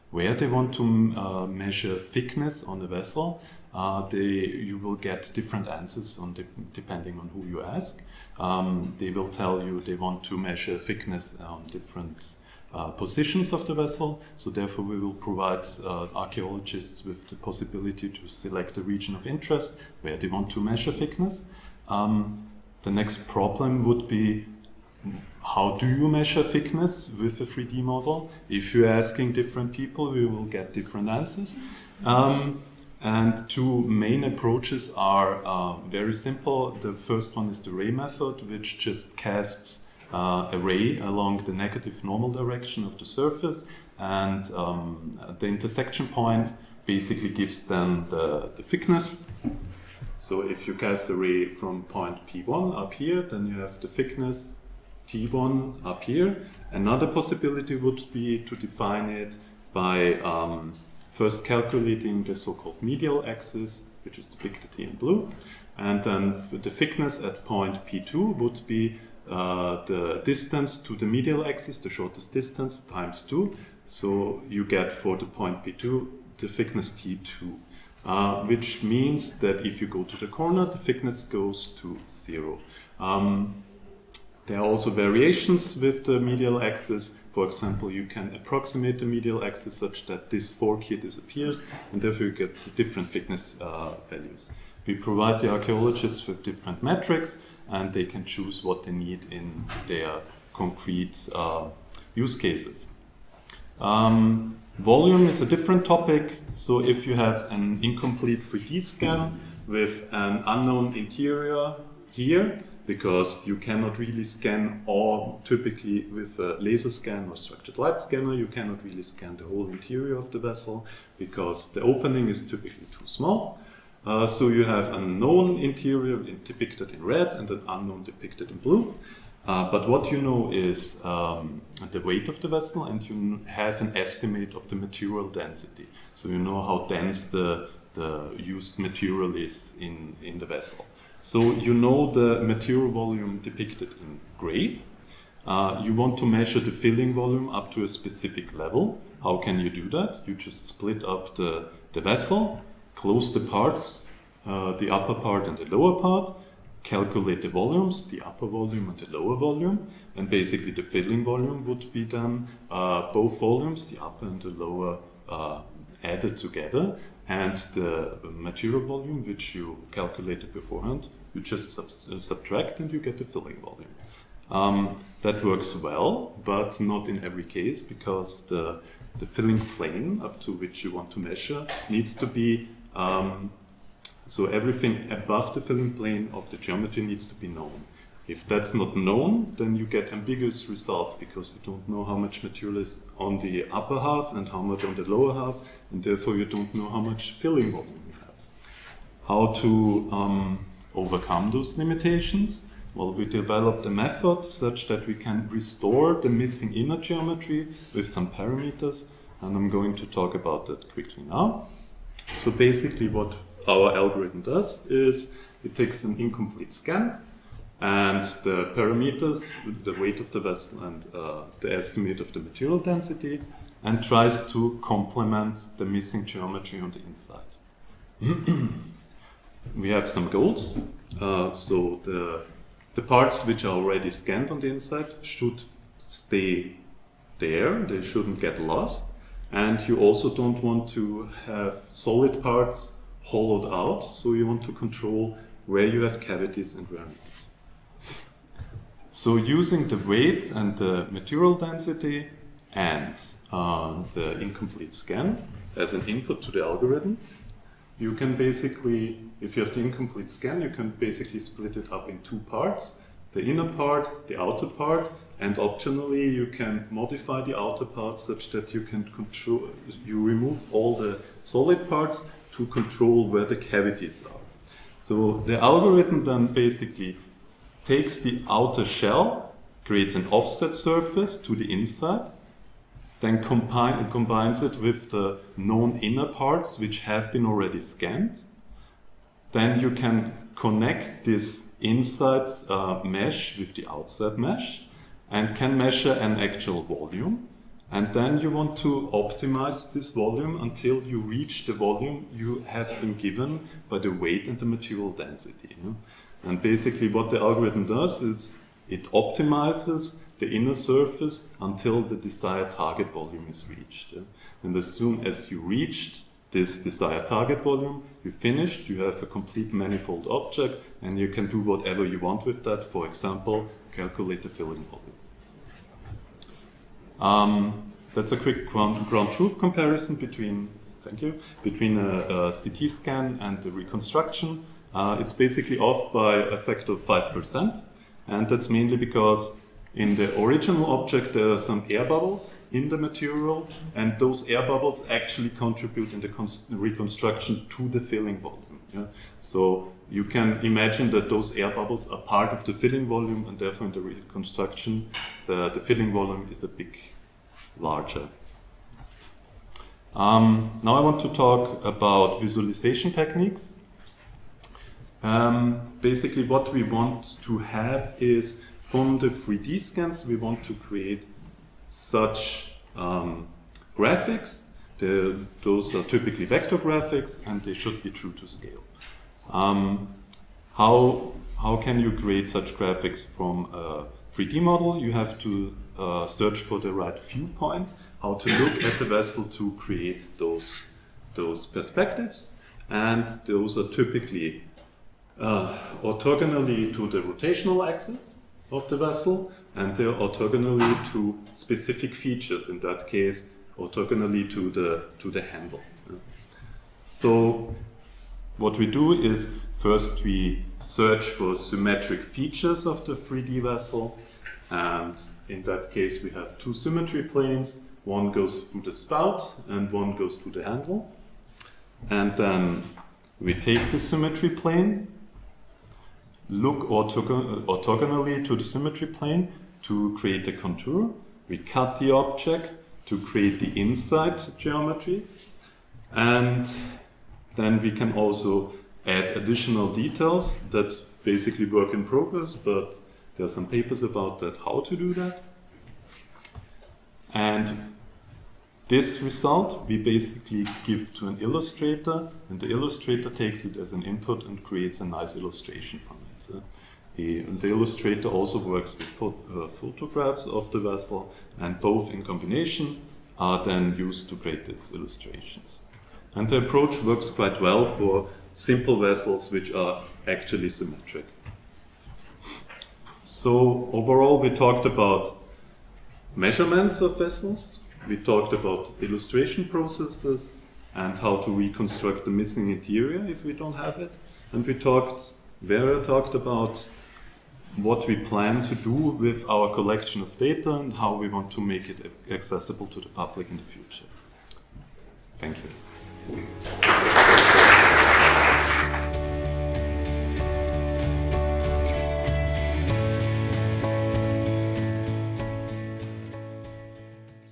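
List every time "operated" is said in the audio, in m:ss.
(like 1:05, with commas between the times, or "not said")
not said.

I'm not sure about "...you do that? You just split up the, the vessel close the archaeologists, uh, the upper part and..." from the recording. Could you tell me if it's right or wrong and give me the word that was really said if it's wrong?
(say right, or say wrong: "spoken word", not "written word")
wrong: "parts", not "archaeologists".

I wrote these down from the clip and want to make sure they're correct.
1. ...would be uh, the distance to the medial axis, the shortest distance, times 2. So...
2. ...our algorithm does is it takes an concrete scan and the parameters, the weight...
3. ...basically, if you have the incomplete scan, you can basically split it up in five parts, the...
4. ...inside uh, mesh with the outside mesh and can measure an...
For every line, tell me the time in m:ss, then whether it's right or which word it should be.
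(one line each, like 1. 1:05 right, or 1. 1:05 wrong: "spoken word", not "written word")
1. 1:08 right
2. 3:33 wrong: "incomplete", not "concrete"
3. 4:18 wrong: "two", not "five"
4. 4:51 right.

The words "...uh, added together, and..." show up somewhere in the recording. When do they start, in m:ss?
2:45.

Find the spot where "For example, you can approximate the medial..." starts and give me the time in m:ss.
1:27.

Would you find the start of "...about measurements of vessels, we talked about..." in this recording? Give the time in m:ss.
7:54.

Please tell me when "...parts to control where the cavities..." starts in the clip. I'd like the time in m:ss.
4:31.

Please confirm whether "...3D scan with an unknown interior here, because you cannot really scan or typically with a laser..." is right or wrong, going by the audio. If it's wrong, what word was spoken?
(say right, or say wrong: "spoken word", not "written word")
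right.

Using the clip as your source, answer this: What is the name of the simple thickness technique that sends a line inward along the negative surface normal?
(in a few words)
Ray method.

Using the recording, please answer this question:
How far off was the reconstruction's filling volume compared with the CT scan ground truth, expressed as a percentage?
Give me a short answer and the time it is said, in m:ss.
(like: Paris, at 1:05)
5%, at 5:36.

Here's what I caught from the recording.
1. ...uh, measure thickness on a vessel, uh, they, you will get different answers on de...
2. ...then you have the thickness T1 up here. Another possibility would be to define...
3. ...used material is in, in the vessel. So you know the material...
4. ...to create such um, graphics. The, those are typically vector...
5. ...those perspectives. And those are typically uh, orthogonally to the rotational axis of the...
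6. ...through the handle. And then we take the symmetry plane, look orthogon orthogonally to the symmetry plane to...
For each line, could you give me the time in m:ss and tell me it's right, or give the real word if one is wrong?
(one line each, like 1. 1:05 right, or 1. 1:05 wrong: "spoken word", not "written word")
1. 0:01 right
2. 0:53 right
3. 2:18 right
4. 6:10 right
5. 6:31 right
6. 7:00 right.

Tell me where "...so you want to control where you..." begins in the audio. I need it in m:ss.
4:04.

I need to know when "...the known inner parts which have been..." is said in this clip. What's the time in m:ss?
4:45.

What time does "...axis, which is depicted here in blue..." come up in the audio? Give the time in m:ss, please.
1:03.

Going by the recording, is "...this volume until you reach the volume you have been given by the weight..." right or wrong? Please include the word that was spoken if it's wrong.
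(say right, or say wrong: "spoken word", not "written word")
right.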